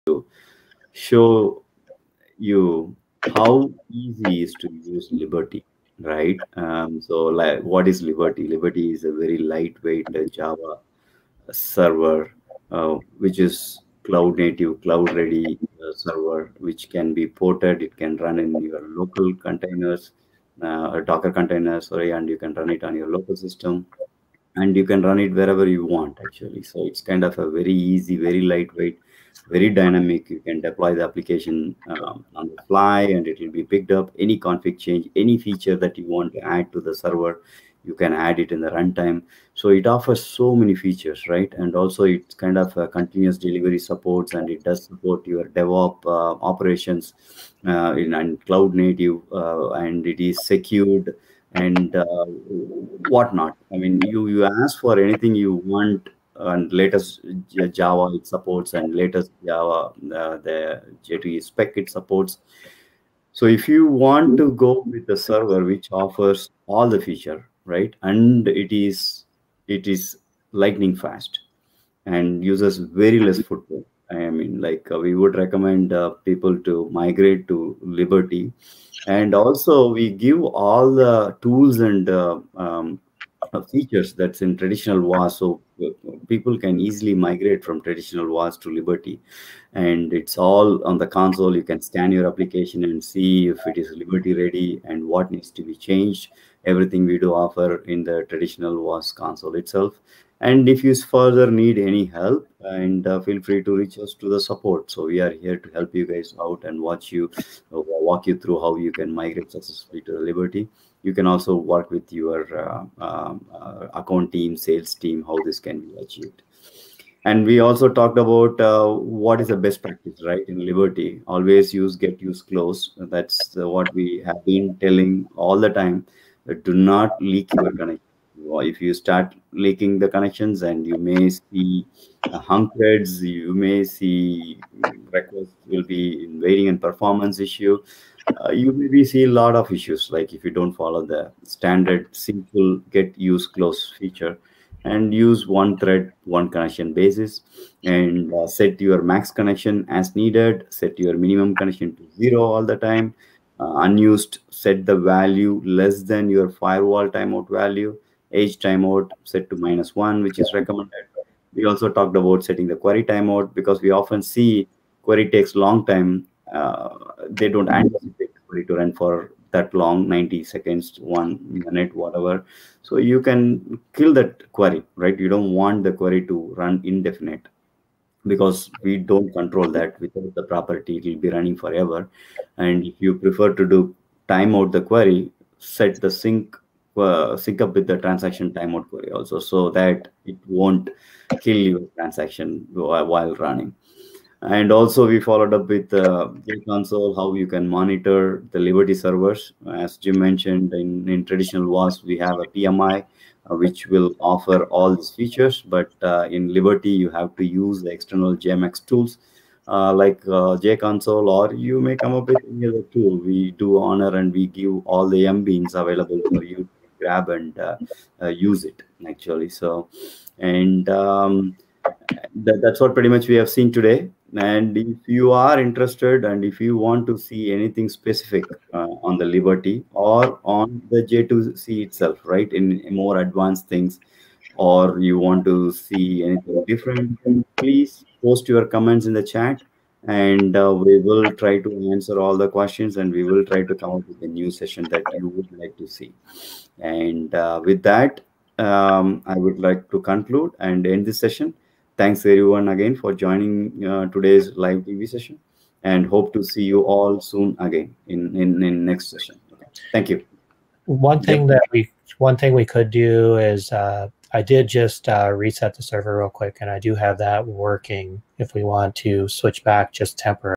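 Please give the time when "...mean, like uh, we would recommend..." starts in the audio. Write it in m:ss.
1:14.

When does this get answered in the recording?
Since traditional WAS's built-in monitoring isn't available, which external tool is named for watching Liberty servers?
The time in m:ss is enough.
3:30.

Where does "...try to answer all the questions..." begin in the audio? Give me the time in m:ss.
4:01.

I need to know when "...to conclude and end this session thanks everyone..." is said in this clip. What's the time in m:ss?
4:09.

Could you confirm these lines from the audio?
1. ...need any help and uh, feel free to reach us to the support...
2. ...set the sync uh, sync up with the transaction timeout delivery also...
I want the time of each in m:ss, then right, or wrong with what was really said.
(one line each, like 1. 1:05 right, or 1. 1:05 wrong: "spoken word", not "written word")
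1. 1:41 right
2. 3:05 wrong: "query", not "delivery".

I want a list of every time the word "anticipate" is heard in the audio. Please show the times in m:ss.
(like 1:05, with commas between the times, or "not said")
2:47.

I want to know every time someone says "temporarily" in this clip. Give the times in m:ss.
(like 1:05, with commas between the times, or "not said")
4:30.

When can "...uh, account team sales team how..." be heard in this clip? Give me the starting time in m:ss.
1:53.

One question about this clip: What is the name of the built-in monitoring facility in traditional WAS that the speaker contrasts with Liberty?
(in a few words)
PMI.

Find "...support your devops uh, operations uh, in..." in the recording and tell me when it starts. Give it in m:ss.
0:44.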